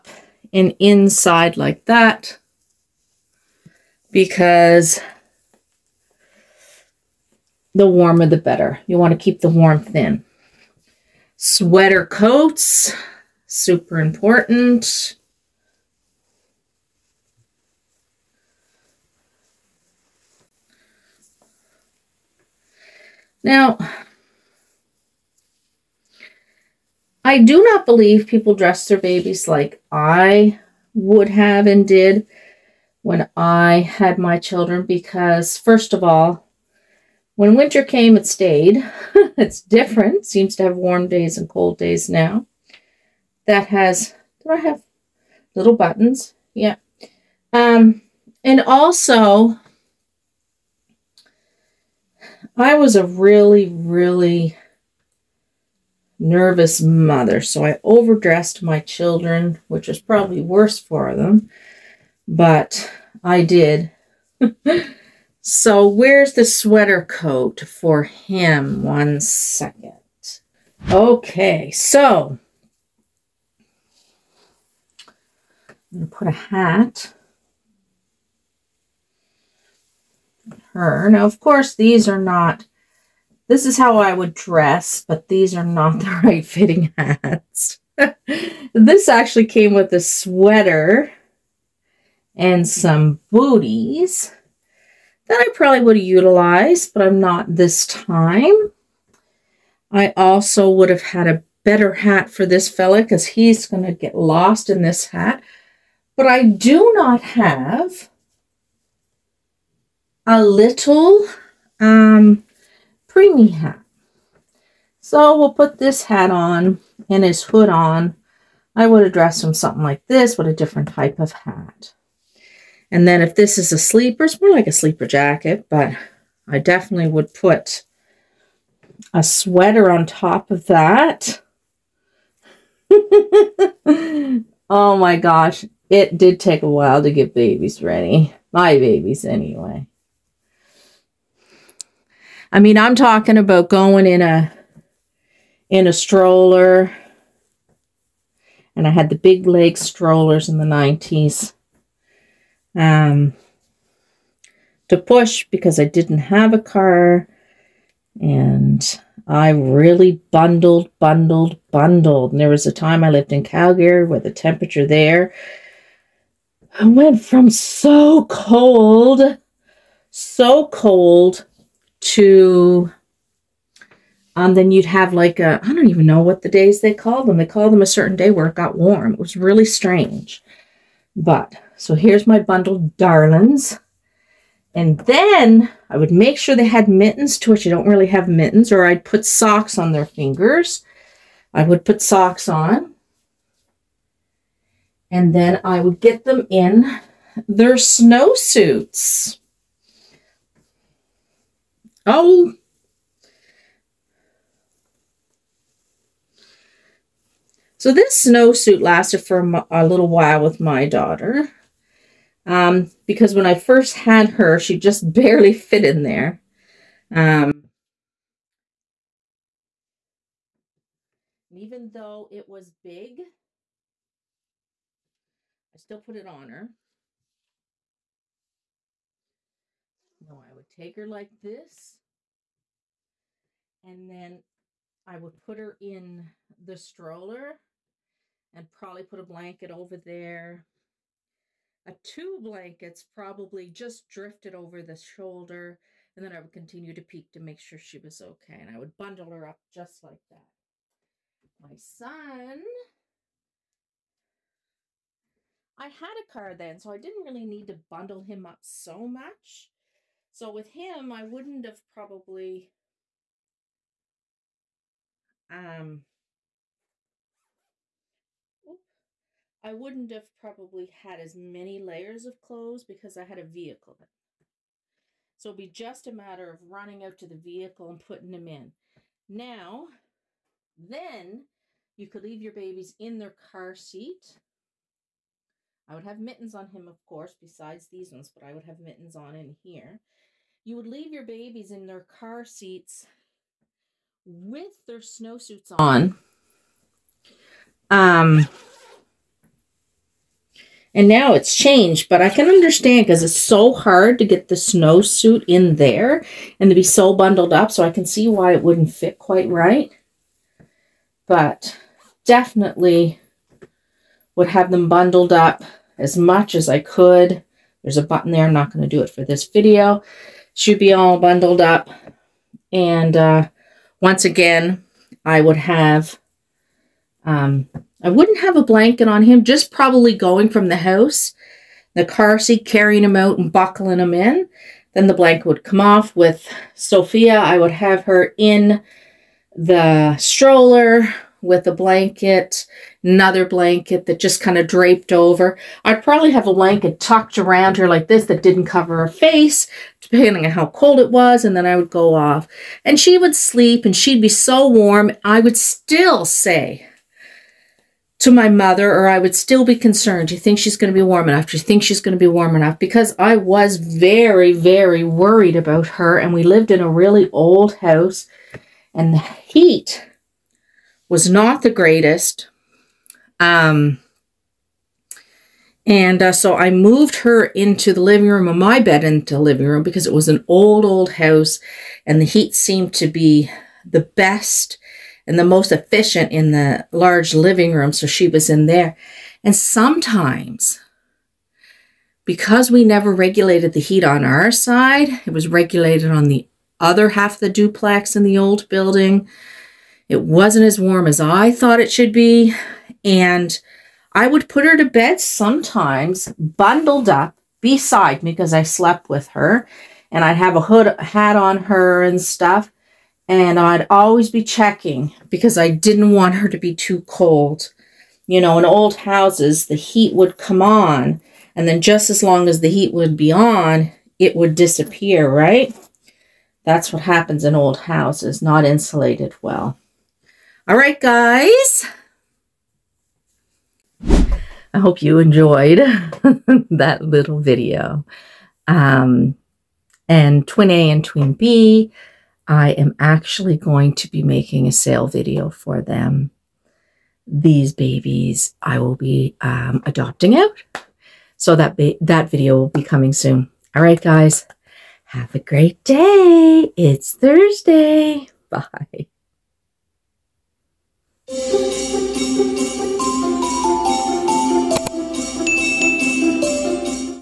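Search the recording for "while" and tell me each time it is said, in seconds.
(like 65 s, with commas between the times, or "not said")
136 s, 210 s.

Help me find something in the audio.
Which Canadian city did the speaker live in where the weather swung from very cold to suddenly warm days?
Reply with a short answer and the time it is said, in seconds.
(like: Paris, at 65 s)
Calgary, at 163 s.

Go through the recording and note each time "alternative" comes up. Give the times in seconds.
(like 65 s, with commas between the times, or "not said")
not said.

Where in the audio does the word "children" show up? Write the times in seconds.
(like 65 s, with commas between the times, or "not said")
34 s, 58 s.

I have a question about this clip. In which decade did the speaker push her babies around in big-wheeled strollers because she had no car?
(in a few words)
1990s.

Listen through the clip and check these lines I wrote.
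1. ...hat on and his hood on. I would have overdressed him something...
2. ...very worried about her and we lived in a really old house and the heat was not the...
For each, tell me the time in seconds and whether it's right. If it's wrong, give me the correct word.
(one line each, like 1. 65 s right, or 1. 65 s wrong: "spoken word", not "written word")
1. 116 s wrong: "dressed", not "overdressed"
2. 364 s right.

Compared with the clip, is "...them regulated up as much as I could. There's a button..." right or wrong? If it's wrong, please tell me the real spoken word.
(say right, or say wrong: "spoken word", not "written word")
wrong: "bundled", not "regulated".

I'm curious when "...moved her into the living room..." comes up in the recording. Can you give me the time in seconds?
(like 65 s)
376 s.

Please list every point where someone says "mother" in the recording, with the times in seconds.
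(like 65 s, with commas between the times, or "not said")
56 s, 358 s.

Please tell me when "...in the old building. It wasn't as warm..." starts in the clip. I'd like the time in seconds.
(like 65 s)
398 s.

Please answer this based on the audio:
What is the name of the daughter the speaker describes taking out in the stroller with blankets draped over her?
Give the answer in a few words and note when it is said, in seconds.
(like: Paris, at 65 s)
Sophia, at 336 s.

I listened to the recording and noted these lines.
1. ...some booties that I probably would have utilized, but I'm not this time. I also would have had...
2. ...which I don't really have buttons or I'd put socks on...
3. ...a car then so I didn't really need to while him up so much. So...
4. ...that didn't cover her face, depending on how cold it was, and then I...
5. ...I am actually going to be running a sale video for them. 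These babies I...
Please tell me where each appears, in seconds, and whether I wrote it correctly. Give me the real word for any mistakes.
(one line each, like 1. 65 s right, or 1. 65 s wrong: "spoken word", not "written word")
1. 92 s right
2. 187 s wrong: "mittens", not "buttons"
3. 256 s wrong: "bundle", not "while"
4. 348 s right
5. 442 s wrong: "making", not "running".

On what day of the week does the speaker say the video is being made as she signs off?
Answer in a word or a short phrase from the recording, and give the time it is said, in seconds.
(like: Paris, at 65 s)
Thursday, at 457 s.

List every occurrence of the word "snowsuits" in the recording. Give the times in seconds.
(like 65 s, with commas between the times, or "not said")
197 s, 208 s, 294 s, 304 s.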